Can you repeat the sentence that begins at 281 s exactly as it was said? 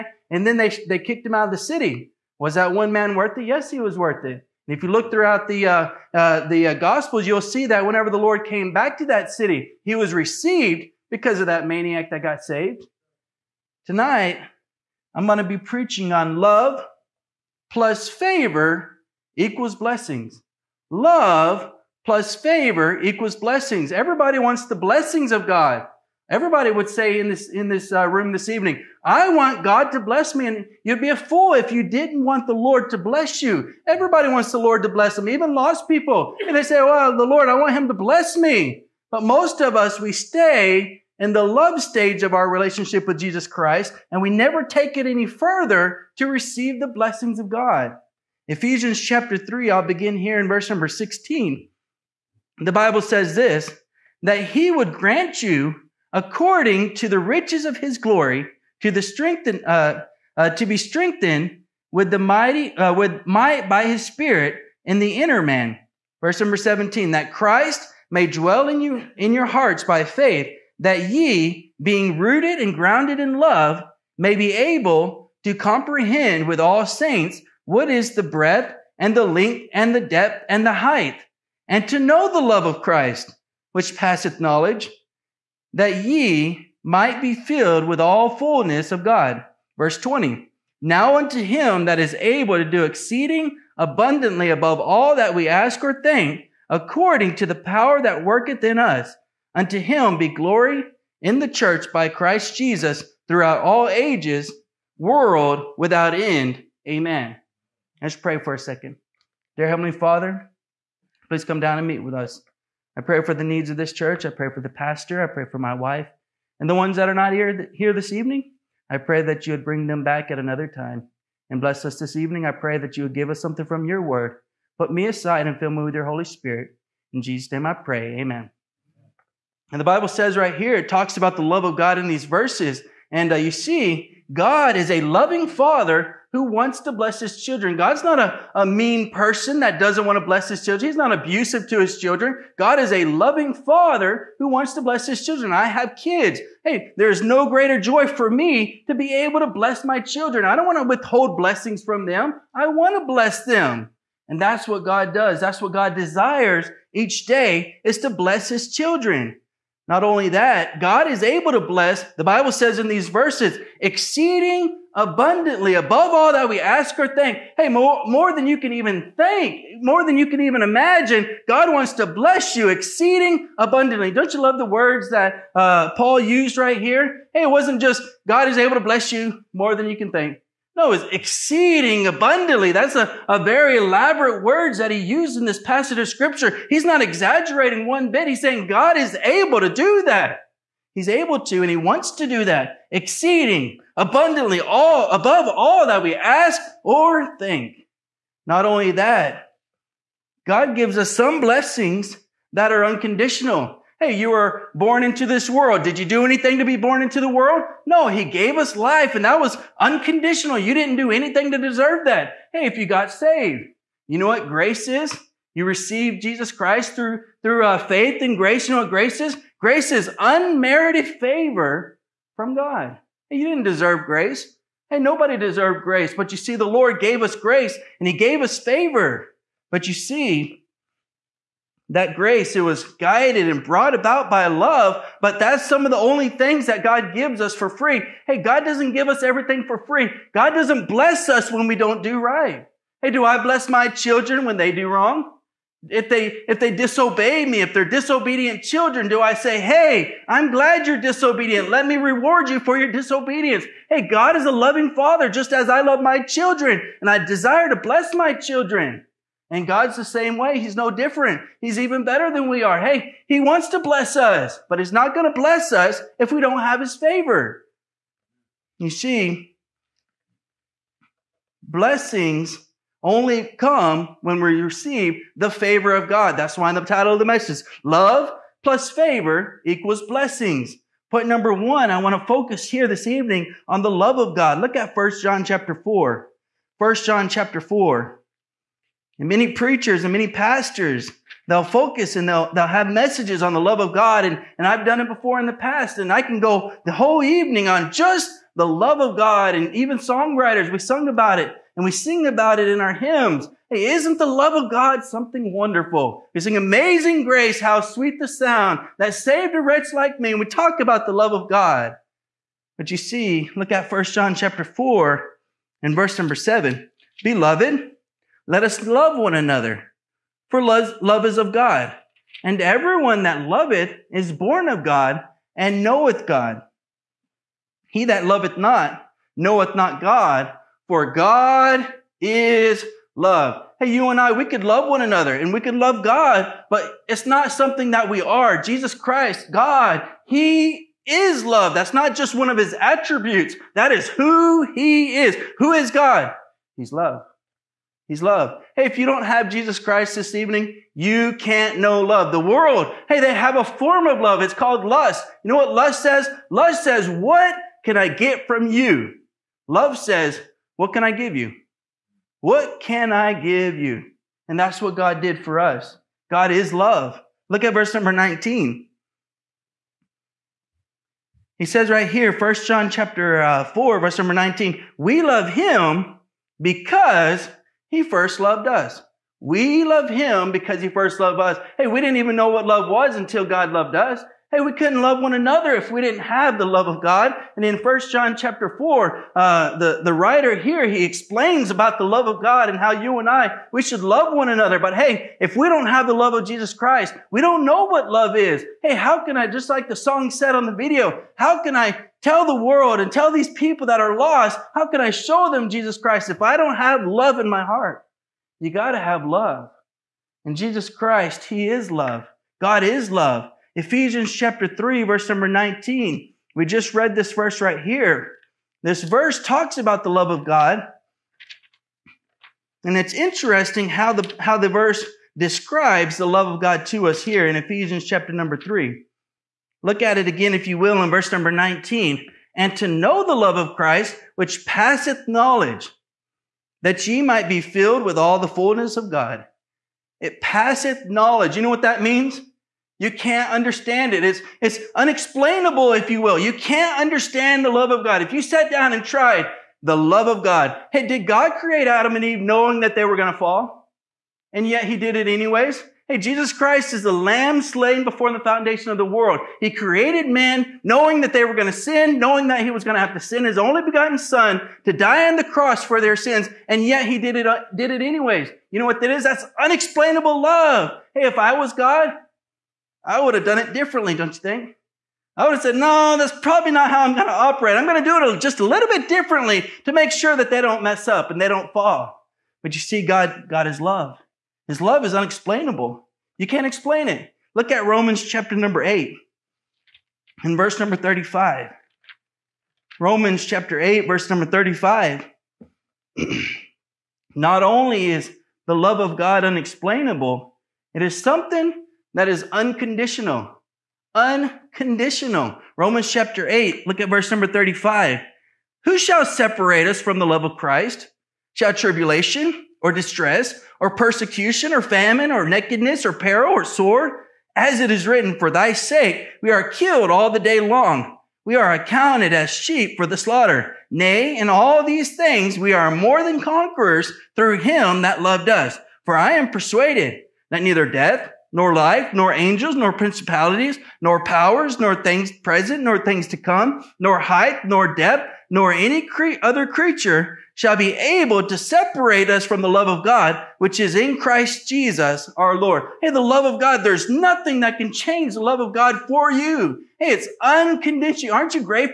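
Point number one, I want to focus here this evening on the love of God.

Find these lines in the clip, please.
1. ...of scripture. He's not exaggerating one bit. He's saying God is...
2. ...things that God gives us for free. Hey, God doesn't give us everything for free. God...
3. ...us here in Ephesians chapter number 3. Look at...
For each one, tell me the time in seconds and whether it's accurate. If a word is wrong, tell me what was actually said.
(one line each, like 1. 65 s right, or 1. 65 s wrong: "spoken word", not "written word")
1. 185 s right
2. 236 s right
3. 427 s right.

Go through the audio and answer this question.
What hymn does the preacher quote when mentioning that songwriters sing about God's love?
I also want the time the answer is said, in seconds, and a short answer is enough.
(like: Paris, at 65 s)
Amazing Grace, at 306 s.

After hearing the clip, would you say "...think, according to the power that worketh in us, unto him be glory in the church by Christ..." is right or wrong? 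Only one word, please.
right.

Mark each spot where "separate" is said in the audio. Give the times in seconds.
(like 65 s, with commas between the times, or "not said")
509 s, 541 s.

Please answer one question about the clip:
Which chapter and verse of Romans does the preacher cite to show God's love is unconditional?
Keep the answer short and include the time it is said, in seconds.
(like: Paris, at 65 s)
Romans 8:35, at 492 s.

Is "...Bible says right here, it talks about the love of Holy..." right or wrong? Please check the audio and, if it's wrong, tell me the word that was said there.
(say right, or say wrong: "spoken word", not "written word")
wrong: "God", not "Holy".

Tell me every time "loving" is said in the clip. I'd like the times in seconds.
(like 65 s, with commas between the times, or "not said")
135 s, 143 s, 254 s.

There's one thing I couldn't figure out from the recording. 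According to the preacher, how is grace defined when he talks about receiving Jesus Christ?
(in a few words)
Unmerited favor from God.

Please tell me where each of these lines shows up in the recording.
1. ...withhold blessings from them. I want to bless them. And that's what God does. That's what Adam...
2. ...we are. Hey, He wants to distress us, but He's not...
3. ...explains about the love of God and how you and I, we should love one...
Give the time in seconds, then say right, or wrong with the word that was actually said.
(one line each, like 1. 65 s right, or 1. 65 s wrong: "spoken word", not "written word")
1. 150 s wrong: "God", not "Adam"
2. 262 s wrong: "bless", not "distress"
3. 391 s right.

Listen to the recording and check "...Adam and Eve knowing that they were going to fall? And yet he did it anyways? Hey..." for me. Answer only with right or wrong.
right.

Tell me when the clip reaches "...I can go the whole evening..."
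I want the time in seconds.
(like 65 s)
296 s.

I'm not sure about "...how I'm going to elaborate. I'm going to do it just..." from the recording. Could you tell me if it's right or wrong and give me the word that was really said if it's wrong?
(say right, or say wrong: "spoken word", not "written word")
wrong: "operate", not "elaborate".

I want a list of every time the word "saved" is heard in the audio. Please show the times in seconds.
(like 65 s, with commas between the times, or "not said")
12 s, 213 s, 309 s.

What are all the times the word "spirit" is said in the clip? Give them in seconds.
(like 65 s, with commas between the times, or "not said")
64 s, 126 s.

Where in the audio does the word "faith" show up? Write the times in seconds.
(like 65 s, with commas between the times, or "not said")
70 s, 217 s.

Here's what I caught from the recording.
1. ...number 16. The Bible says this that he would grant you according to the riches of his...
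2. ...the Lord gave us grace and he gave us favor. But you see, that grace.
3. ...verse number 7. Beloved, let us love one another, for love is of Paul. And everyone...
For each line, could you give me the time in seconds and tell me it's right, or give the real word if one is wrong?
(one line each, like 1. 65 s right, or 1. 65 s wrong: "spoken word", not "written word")
1. 50 s right
2. 226 s right
3. 315 s wrong: "God", not "Paul".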